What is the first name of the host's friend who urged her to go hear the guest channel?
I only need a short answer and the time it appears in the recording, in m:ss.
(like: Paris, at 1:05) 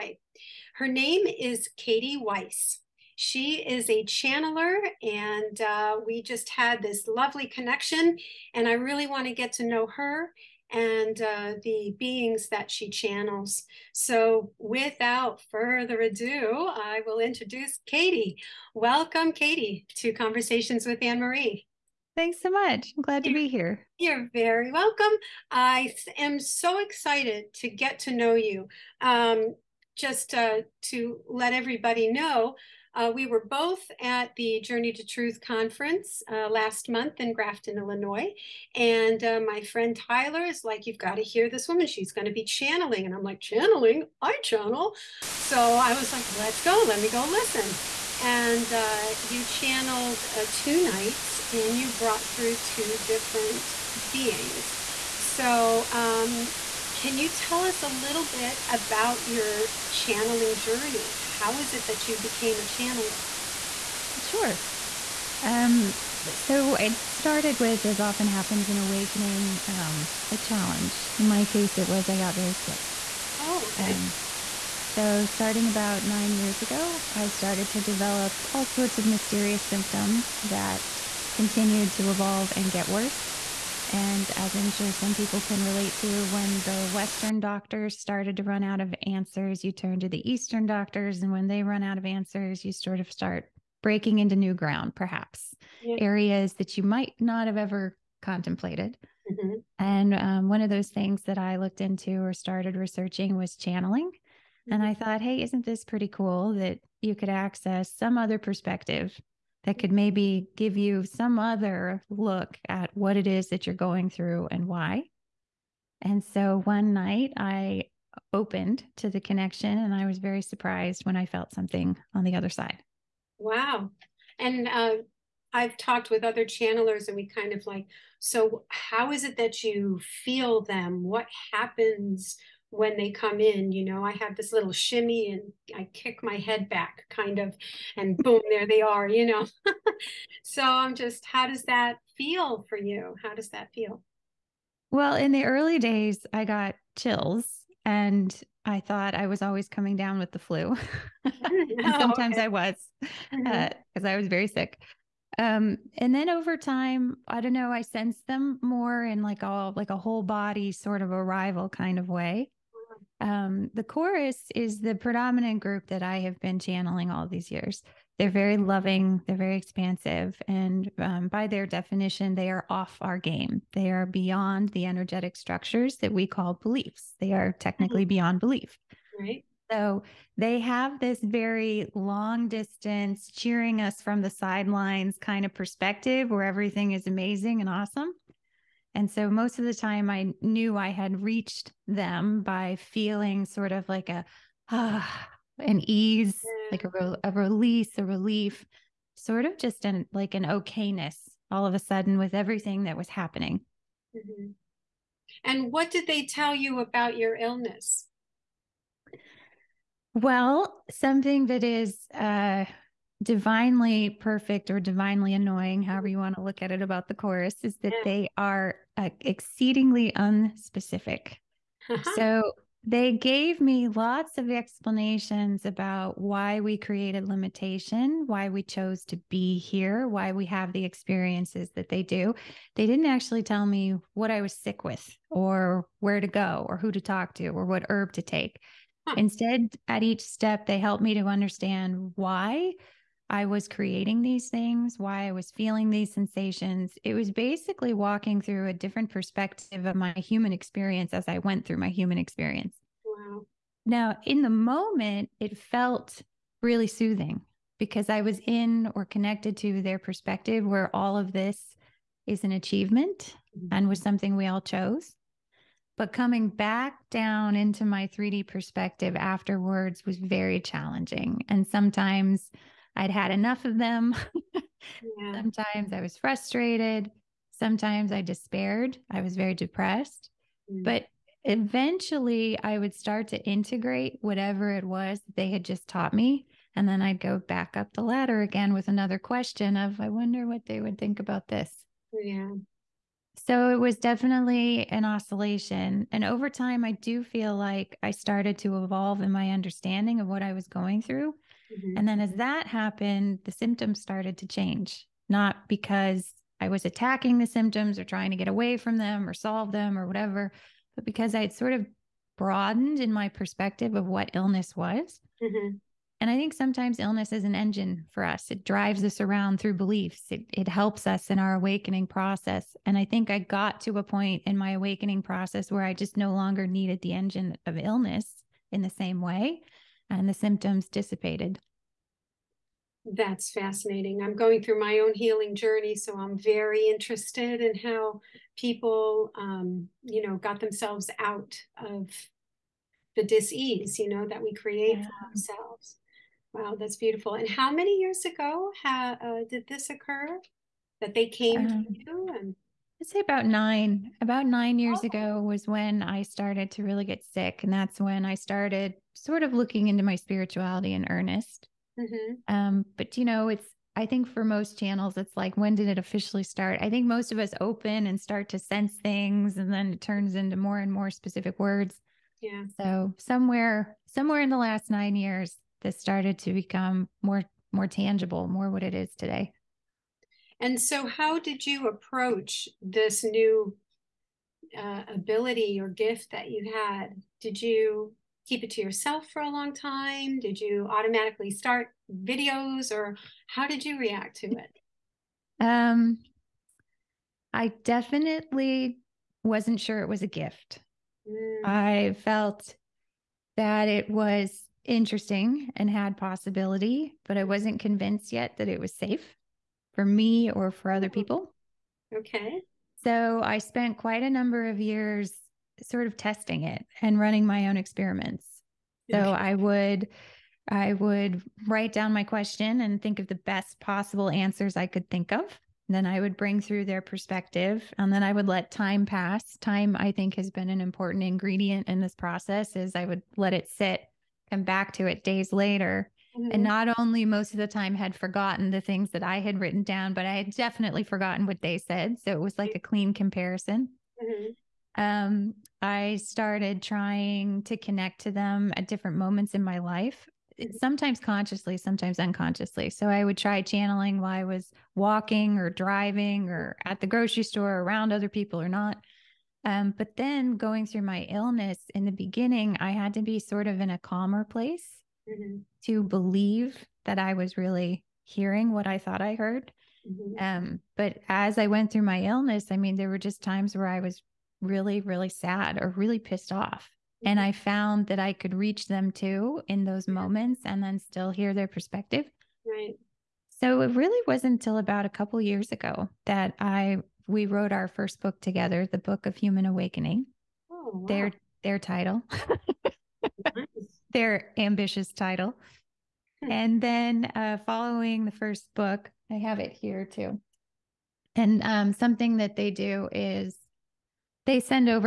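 Tyler, at 0:39.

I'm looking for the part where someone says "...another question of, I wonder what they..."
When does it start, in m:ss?
4:48.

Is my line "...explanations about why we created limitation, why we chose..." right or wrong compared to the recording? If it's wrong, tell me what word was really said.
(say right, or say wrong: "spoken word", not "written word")
right.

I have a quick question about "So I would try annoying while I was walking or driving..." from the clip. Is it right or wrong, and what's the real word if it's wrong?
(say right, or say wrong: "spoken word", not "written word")
wrong: "channeling", not "annoying".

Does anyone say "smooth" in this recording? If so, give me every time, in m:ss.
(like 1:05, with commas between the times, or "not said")
not said.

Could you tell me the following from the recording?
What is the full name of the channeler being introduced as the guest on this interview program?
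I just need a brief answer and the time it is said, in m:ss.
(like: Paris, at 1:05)
Katie Weiss, at 0:01.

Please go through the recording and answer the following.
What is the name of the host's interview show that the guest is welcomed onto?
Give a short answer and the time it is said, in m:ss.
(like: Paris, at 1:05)
Conversations with Ann Marie, at 0:20.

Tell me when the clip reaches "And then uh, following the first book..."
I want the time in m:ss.
8:16.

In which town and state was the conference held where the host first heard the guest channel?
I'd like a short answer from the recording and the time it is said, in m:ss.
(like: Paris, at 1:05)
Grafton, Illinois, at 0:37.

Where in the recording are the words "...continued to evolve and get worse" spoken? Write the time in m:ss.
1:21.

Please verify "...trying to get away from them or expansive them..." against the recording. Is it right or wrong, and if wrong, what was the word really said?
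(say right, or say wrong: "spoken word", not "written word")
wrong: "solve", not "expansive".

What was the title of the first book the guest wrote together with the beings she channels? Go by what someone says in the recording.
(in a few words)
the Book of Human Awakening.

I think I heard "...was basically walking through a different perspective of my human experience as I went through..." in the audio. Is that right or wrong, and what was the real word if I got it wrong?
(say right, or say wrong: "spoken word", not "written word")
right.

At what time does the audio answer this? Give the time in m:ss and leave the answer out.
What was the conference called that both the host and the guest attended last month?
0:34.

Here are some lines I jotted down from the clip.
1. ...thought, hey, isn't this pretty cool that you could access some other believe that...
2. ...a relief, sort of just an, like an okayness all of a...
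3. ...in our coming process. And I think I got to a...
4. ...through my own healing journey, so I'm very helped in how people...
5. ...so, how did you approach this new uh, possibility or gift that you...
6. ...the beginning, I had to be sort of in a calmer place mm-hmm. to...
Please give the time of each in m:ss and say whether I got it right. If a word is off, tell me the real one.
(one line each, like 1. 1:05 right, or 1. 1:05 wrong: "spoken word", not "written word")
1. 1:44 wrong: "perspective", not "believe"
2. 3:17 right
3. 5:21 wrong: "awakening", not "coming"
4. 5:34 wrong: "interested", not "helped"
5. 6:20 wrong: "ability", not "possibility"
6. 7:42 right.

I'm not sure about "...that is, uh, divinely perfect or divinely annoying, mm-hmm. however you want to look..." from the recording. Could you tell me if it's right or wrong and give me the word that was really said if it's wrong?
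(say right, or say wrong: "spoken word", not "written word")
right.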